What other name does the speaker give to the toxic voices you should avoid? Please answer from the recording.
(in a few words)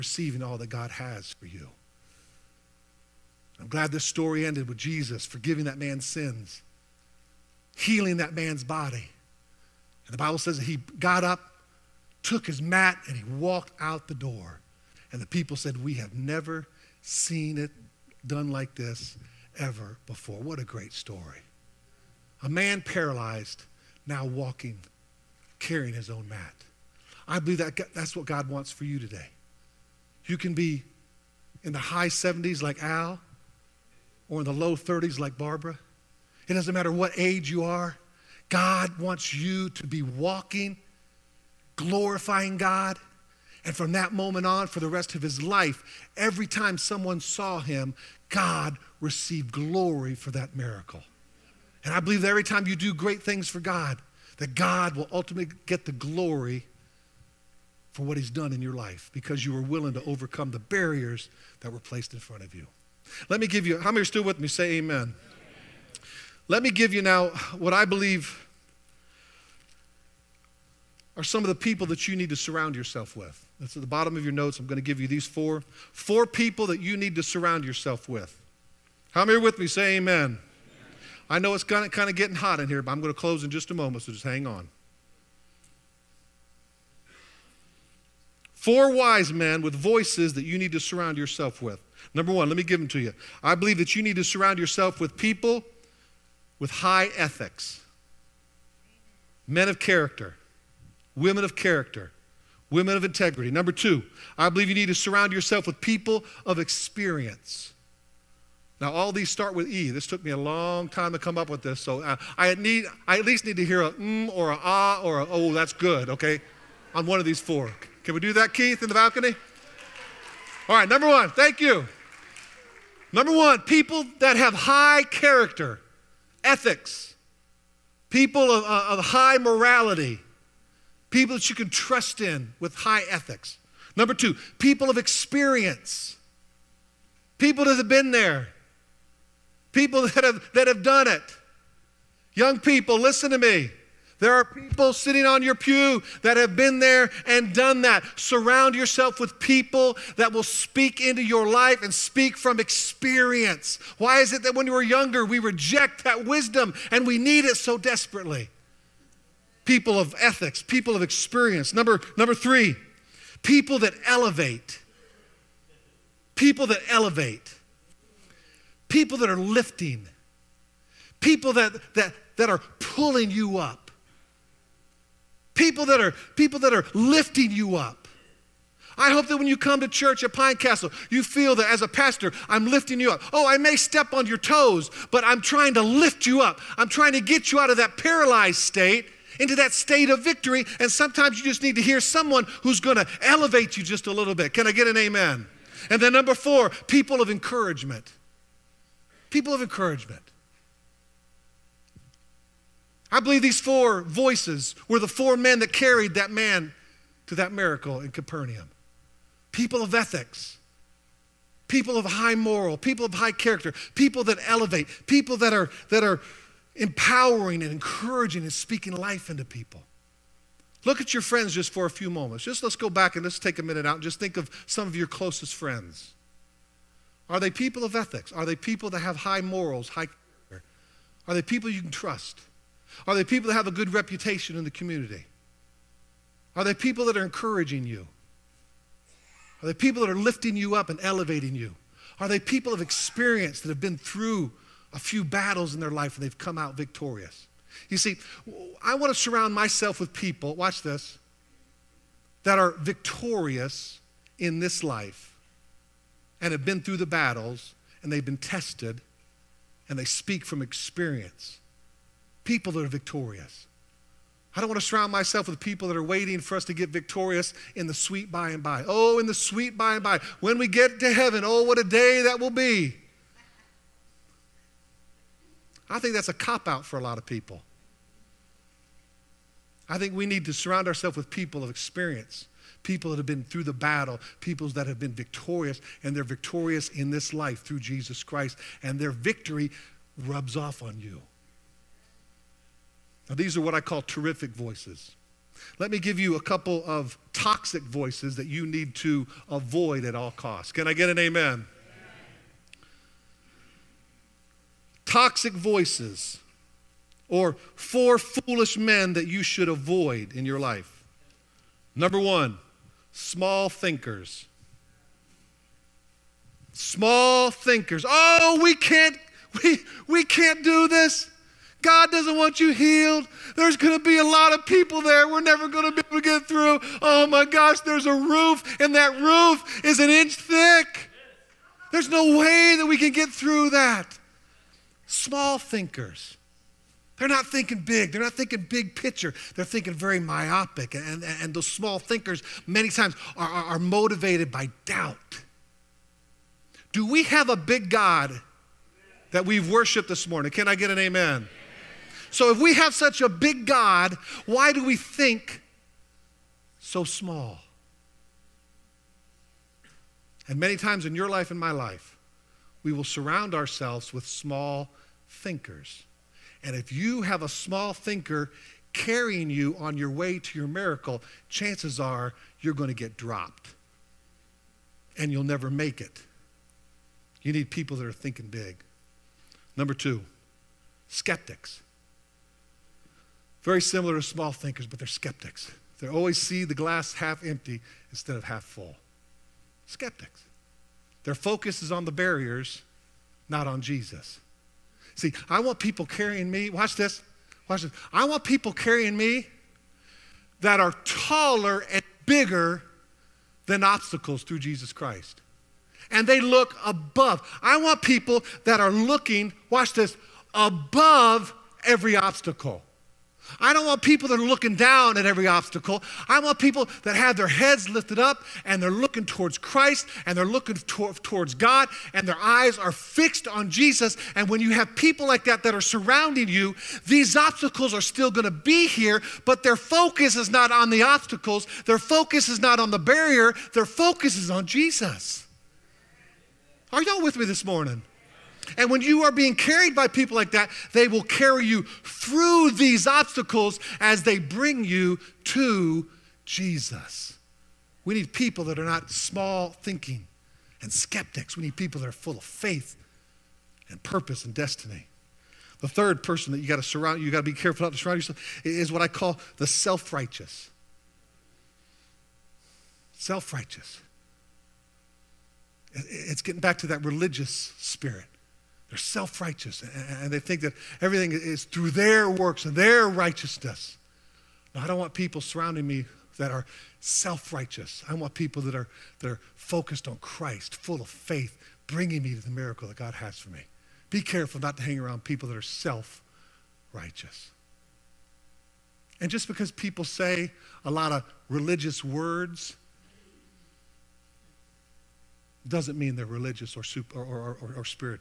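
four foolish men.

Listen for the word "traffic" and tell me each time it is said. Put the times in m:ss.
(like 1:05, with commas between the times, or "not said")
not said.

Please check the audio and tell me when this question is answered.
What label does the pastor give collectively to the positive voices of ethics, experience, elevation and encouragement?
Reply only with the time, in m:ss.
4:54.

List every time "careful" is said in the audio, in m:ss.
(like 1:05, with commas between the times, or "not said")
7:37, 8:04.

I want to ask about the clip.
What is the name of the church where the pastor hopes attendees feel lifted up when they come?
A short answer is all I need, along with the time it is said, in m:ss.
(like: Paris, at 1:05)
Pine Castle, at 3:00.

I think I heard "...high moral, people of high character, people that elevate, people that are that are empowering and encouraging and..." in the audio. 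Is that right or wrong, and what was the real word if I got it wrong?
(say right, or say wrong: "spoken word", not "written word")
right.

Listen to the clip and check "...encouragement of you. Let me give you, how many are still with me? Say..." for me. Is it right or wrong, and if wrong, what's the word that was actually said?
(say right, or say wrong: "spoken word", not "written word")
wrong: "front", not "encouragement".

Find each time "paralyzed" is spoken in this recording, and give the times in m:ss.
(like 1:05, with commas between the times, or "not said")
0:22, 3:07.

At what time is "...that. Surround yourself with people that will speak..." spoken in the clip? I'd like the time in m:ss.
2:27.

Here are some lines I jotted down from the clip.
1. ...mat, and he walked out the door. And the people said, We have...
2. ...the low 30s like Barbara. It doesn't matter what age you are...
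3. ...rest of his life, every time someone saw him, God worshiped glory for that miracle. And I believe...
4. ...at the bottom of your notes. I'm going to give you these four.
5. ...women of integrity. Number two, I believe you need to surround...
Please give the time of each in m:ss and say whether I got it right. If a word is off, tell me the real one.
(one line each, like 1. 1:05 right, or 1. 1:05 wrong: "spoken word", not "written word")
1. 0:12 right
2. 0:34 right
3. 0:44 wrong: "received", not "worshiped"
4. 1:13 right
5. 1:42 right.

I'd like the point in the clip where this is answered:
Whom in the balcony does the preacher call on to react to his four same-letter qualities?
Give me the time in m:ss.
1:58.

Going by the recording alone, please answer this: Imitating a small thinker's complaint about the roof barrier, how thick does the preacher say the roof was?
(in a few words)
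an inch thick.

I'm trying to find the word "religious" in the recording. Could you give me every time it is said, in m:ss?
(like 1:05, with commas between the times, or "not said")
7:47, 8:11, 8:16.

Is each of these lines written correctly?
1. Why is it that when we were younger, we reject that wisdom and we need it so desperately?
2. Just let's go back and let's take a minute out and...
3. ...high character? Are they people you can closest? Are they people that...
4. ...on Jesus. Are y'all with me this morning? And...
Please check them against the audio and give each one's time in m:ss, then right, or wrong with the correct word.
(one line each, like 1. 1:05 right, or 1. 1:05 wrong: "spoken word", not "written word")
1. 2:33 right
2. 3:42 right
3. 3:49 wrong: "trust", not "closest"
4. 7:14 right.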